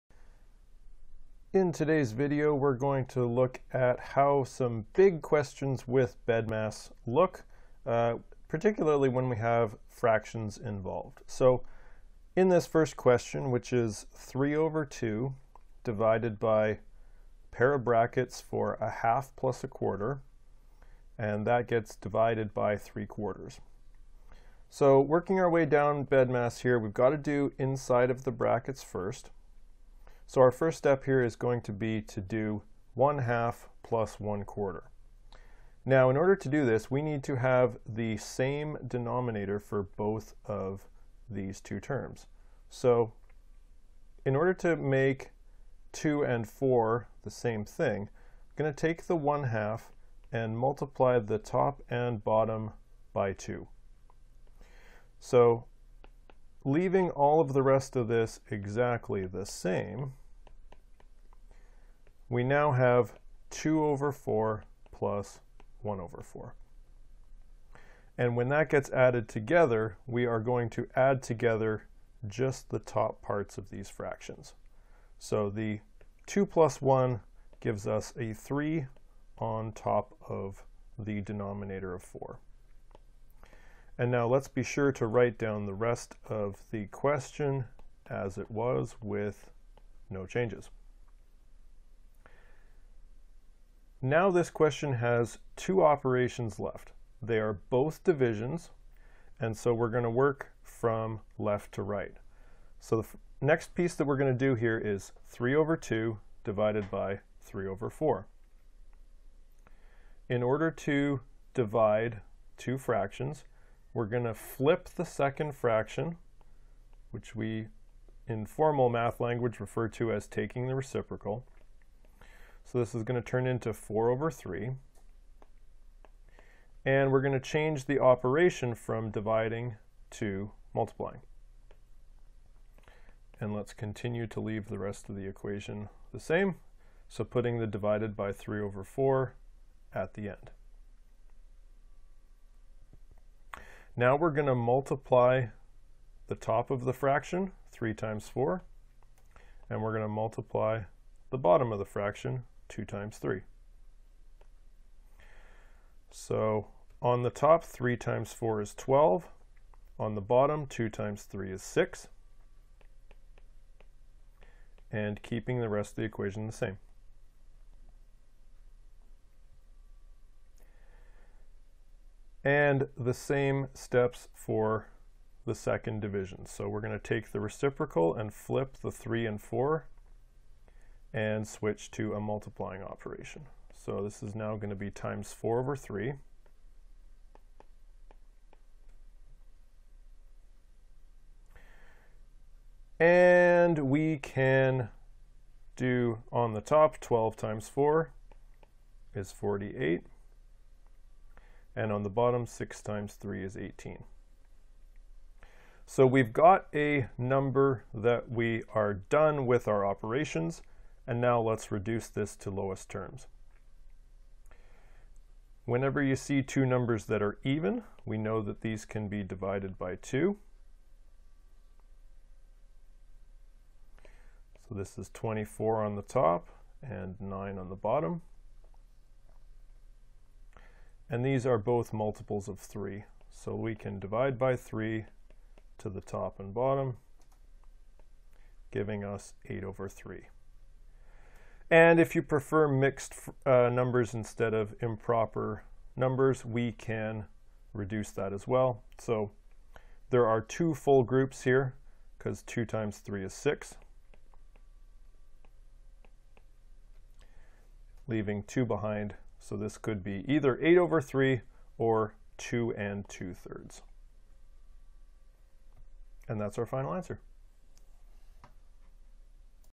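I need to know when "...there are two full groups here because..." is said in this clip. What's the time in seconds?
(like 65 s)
250 s.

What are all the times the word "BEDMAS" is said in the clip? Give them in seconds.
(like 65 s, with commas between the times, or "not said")
6 s, 26 s.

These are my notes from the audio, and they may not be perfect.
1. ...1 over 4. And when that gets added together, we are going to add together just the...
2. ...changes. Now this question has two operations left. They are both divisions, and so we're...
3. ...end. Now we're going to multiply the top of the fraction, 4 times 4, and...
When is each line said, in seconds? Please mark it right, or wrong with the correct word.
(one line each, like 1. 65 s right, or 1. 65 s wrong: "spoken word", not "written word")
1. 65 s right
2. 90 s right
3. 140 s wrong: "3", not "4".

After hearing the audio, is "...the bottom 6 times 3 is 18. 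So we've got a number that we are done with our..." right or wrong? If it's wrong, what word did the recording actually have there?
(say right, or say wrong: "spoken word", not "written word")
right.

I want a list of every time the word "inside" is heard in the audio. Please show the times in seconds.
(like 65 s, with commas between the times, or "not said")
27 s.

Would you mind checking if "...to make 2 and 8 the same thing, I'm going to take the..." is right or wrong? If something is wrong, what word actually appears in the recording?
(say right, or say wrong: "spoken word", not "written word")
wrong: "4", not "8".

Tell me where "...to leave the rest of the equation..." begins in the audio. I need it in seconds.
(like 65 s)
134 s.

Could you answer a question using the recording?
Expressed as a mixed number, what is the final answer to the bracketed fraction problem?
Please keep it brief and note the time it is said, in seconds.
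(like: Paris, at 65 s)
2 and 2/3, at 262 s.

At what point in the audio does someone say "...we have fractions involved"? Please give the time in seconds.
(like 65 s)
9 s.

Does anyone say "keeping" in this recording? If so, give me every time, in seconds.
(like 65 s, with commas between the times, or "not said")
165 s.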